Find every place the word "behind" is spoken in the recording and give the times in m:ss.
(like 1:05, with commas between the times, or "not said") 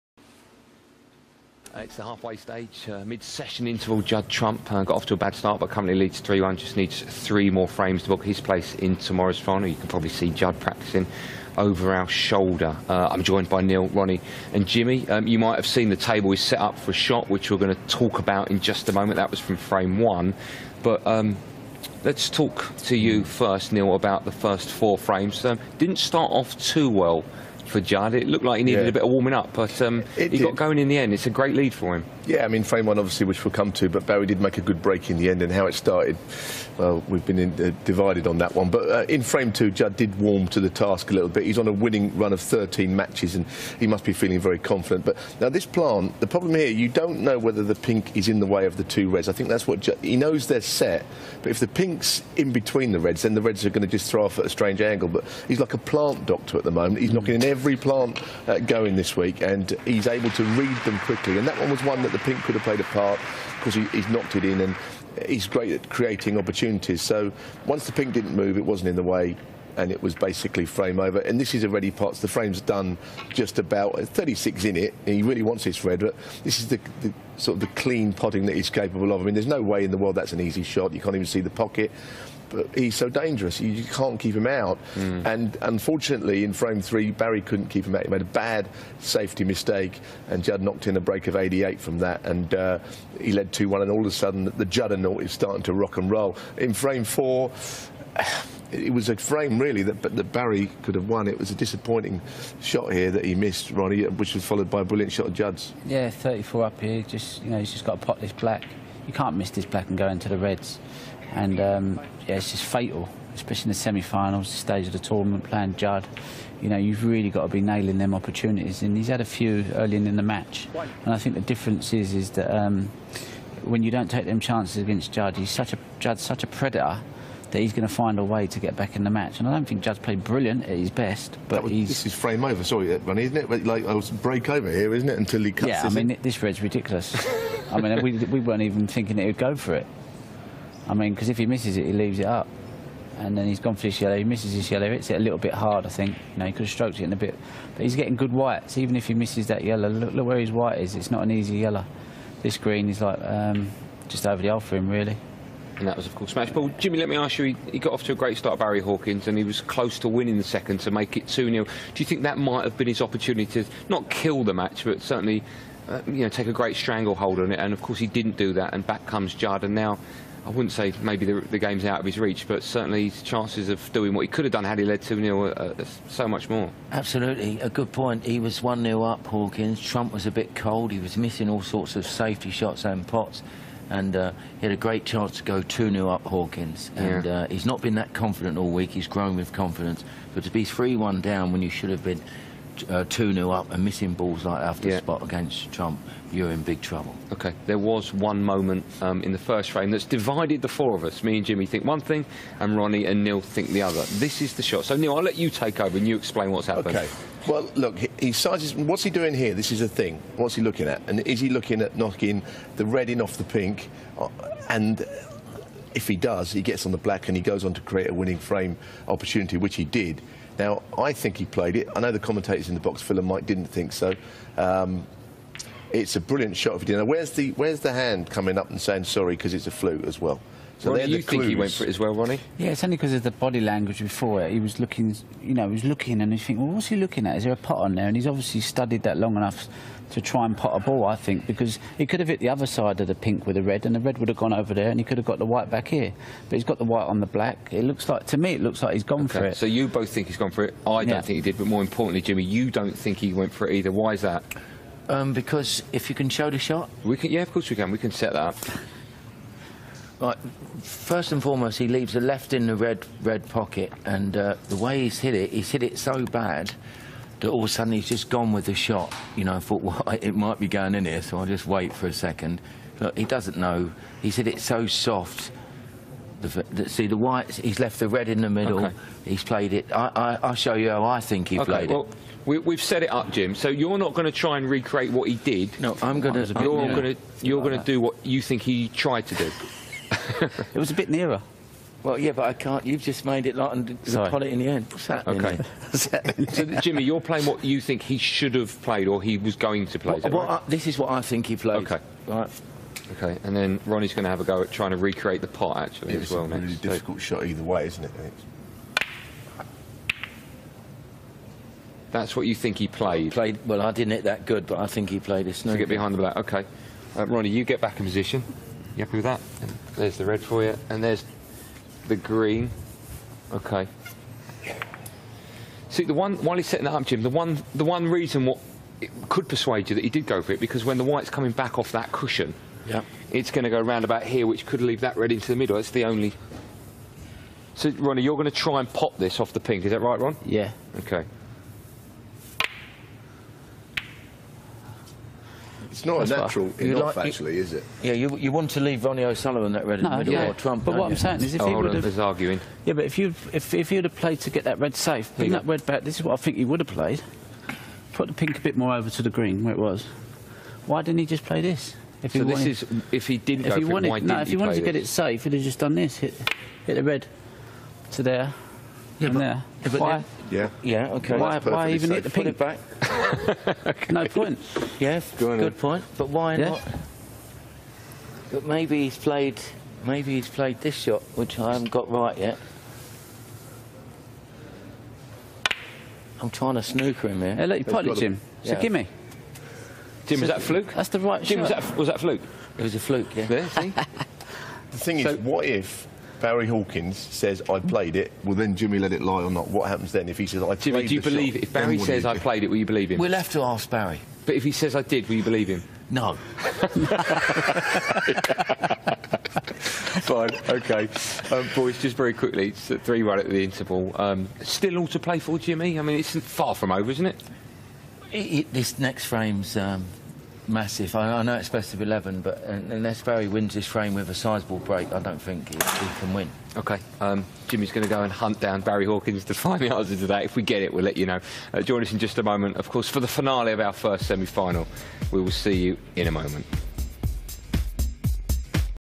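5:15.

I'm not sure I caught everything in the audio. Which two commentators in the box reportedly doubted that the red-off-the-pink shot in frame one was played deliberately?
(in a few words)
Phil and Mike.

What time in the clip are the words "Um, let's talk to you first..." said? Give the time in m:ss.
0:21.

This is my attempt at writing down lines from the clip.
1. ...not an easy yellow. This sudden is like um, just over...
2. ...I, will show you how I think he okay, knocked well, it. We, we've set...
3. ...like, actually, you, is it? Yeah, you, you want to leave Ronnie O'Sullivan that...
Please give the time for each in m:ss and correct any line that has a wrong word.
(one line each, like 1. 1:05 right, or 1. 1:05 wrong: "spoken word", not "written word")
1. 2:31 wrong: "green", not "sudden"
2. 4:40 wrong: "played", not "knocked"
3. 5:47 right.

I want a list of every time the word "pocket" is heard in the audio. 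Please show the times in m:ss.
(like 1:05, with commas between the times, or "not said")
1:21, 4:23.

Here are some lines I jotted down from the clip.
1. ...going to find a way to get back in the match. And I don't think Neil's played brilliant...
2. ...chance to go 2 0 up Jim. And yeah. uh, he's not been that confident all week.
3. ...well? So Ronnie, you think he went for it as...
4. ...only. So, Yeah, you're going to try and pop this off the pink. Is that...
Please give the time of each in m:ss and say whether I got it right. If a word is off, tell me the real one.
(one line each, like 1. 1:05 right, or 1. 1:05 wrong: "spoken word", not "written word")
1. 2:07 wrong: "Judd", not "Neil"
2. 3:05 wrong: "Hawkins", not "Jim"
3. 3:50 right
4. 5:36 wrong: "Ronnie", not "Yeah".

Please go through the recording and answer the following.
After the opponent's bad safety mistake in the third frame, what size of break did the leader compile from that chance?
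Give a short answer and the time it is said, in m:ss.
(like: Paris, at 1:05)
88, at 1:31.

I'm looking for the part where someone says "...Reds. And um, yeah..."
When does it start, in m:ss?
1:50.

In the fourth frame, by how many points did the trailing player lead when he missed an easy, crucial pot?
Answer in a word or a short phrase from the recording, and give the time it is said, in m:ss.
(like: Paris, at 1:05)
34, at 1:46.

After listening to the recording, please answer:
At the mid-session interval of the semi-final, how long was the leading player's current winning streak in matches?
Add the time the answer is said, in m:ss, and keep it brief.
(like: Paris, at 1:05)
13, at 0:42.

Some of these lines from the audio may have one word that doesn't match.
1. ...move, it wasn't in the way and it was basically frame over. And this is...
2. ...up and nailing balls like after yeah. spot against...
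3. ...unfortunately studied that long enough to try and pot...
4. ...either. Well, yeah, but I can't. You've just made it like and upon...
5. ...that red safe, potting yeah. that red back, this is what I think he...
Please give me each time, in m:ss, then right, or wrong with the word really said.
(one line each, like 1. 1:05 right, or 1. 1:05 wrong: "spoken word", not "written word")
1. 1:08 right
2. 3:13 wrong: "missing", not "nailing"
3. 3:58 wrong: "obviously", not "unfortunately"
4. 4:51 wrong: "nearer", not "either"
5. 5:54 wrong: "bring", not "potting".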